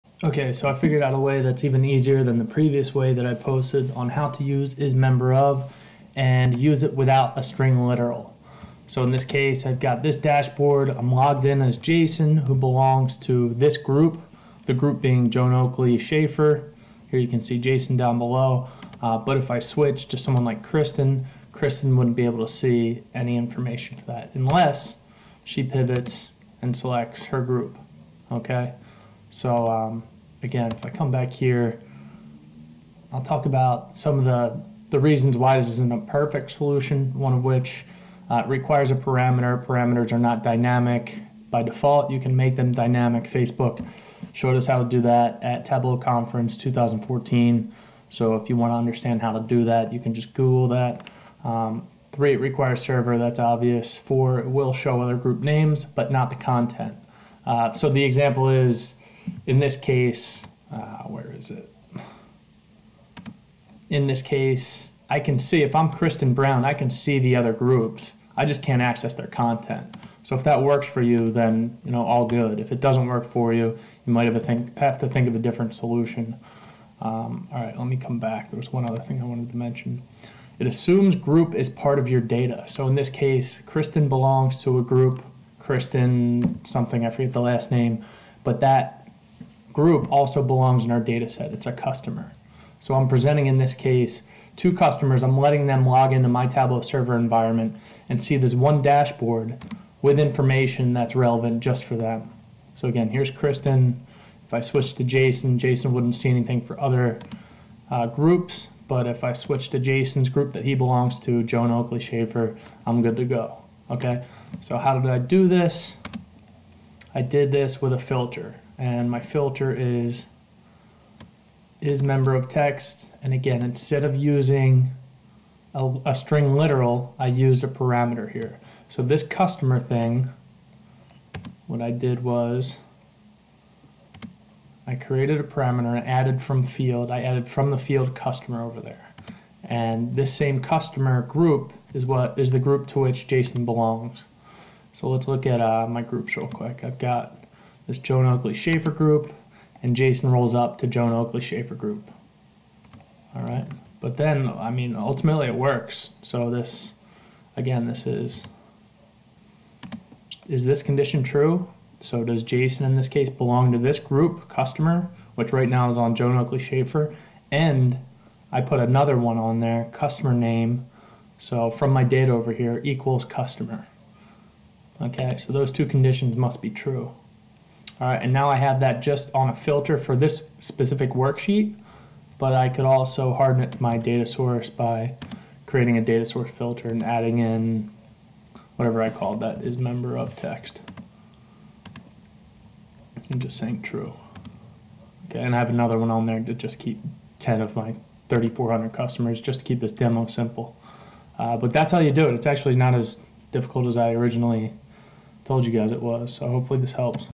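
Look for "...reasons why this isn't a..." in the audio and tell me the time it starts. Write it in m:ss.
0:34.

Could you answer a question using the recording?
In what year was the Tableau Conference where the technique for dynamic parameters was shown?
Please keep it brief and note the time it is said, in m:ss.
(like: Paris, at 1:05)
2014, at 0:46.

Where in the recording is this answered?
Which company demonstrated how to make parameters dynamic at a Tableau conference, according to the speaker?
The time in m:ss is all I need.
0:43.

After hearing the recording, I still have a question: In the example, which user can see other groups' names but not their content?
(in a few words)
Kristen Brown.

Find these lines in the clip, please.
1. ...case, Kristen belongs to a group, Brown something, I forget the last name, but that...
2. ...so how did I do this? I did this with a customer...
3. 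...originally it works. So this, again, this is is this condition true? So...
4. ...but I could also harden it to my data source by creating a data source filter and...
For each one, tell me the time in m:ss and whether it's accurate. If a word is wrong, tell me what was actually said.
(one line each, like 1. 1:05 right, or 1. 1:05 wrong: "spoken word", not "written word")
1. 1:23 wrong: "Kristen", not "Brown"
2. 1:54 wrong: "filter", not "customer"
3. 2:34 wrong: "ultimately", not "originally"
4. 3:02 right.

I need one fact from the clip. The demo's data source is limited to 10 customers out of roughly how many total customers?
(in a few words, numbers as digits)
3,400.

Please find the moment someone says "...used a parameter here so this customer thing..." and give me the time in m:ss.
2:07.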